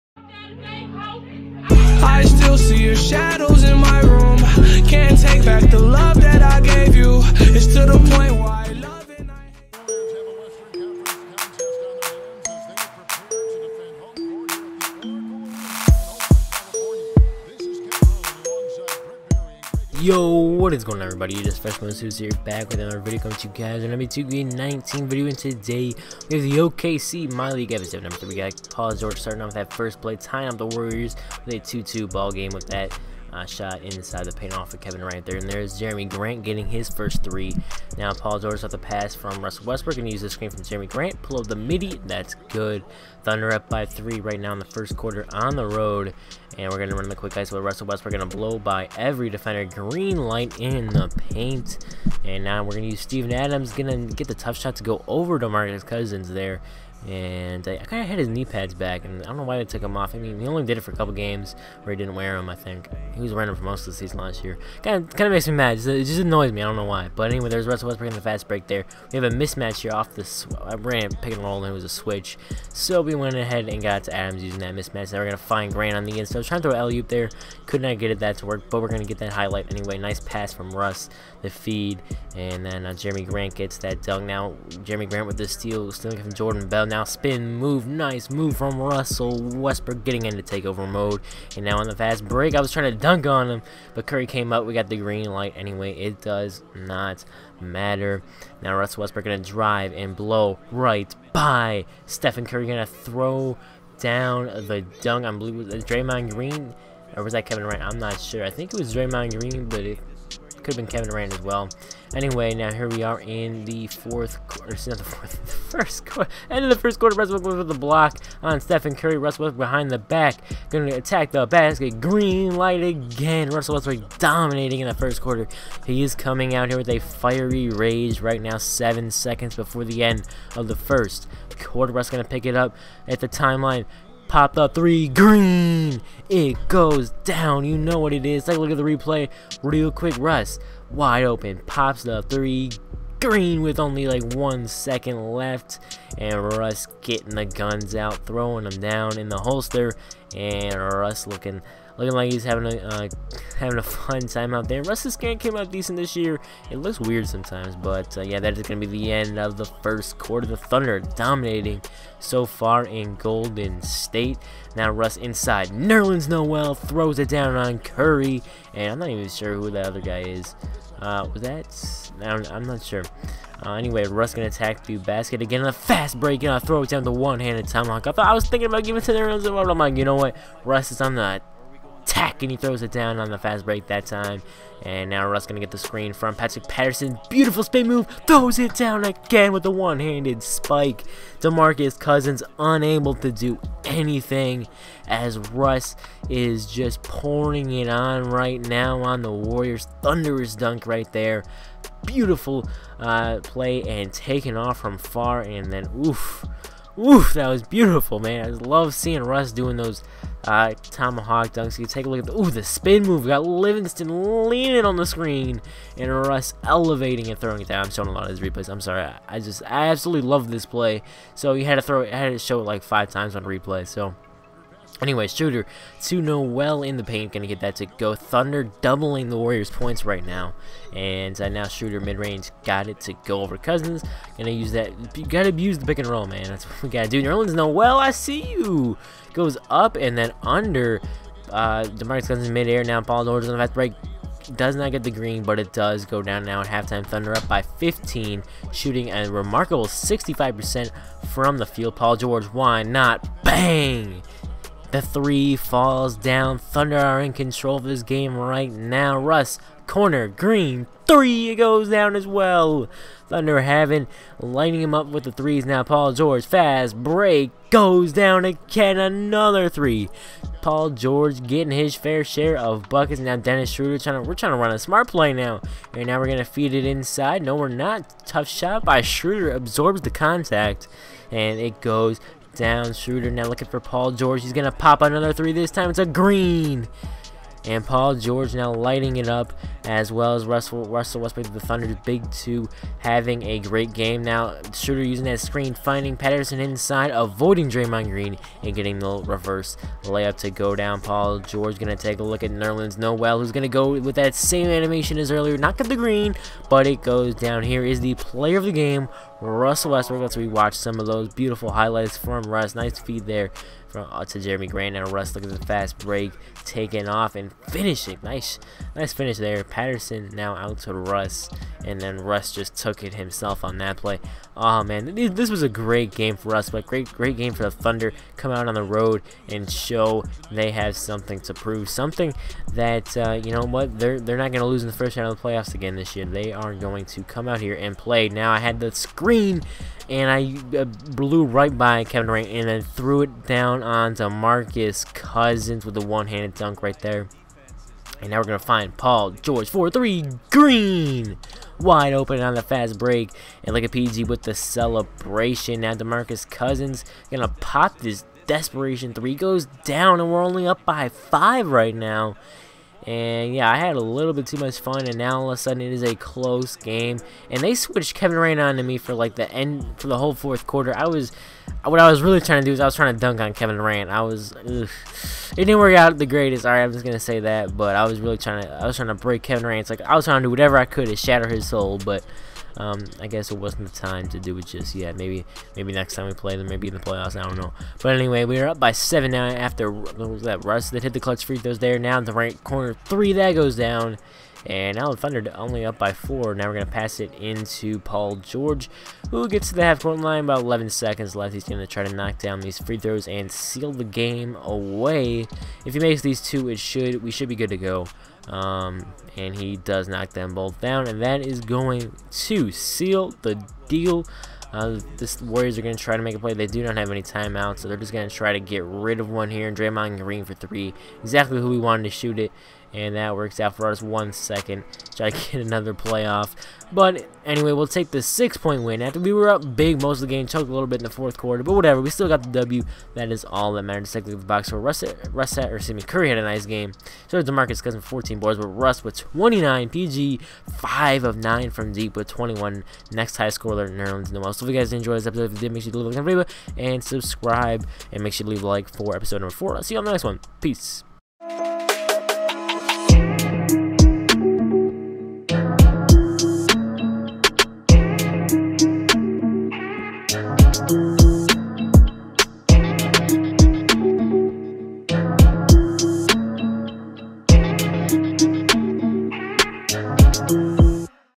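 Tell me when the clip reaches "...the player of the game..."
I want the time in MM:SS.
05:08.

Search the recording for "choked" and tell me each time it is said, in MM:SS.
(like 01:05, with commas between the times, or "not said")
07:10.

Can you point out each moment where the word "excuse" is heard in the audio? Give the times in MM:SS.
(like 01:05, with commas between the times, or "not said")
07:15.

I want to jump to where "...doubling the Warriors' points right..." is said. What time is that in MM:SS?
03:48.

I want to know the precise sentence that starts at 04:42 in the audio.
Schroeder now looking for Paul George.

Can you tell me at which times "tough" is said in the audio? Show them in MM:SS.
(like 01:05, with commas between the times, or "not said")
00:54, 04:38.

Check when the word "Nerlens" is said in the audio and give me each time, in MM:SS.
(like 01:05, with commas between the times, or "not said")
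02:45, 02:59, 03:57, 05:02, 07:23.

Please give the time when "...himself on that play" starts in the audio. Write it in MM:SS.
05:23.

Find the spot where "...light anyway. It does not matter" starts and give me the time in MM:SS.
01:35.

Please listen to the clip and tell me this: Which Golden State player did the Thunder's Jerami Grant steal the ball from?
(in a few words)
Jordan Bell.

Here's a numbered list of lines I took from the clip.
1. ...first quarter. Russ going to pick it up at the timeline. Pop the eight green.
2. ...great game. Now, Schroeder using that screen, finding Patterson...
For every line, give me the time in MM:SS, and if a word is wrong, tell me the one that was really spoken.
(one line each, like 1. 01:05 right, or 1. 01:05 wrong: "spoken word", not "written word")
1. 02:10 wrong: "three", not "eight"
2. 04:53 right.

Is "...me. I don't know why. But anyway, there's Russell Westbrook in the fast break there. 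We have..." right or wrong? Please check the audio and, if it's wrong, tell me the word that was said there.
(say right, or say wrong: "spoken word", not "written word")
right.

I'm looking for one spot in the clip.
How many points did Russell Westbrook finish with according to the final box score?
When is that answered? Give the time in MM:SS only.
07:19.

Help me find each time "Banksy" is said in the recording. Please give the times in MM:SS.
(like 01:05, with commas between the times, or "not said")
not said.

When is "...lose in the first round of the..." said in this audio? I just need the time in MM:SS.
05:34.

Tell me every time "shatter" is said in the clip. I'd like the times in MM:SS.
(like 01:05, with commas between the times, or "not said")
06:21.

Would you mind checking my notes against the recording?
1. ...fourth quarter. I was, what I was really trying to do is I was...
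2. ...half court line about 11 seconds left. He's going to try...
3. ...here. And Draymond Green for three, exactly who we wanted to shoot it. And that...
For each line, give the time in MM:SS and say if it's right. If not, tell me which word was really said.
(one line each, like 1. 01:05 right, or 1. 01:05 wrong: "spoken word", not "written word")
1. 06:10 right
2. 06:39 right
3. 06:59 right.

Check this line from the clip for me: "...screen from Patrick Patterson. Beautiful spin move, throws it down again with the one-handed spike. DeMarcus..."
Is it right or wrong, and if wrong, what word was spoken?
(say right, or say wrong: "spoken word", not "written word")
right.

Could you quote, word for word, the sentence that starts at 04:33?
Now Dennis Schroeder trying to we're trying to run a smart play now.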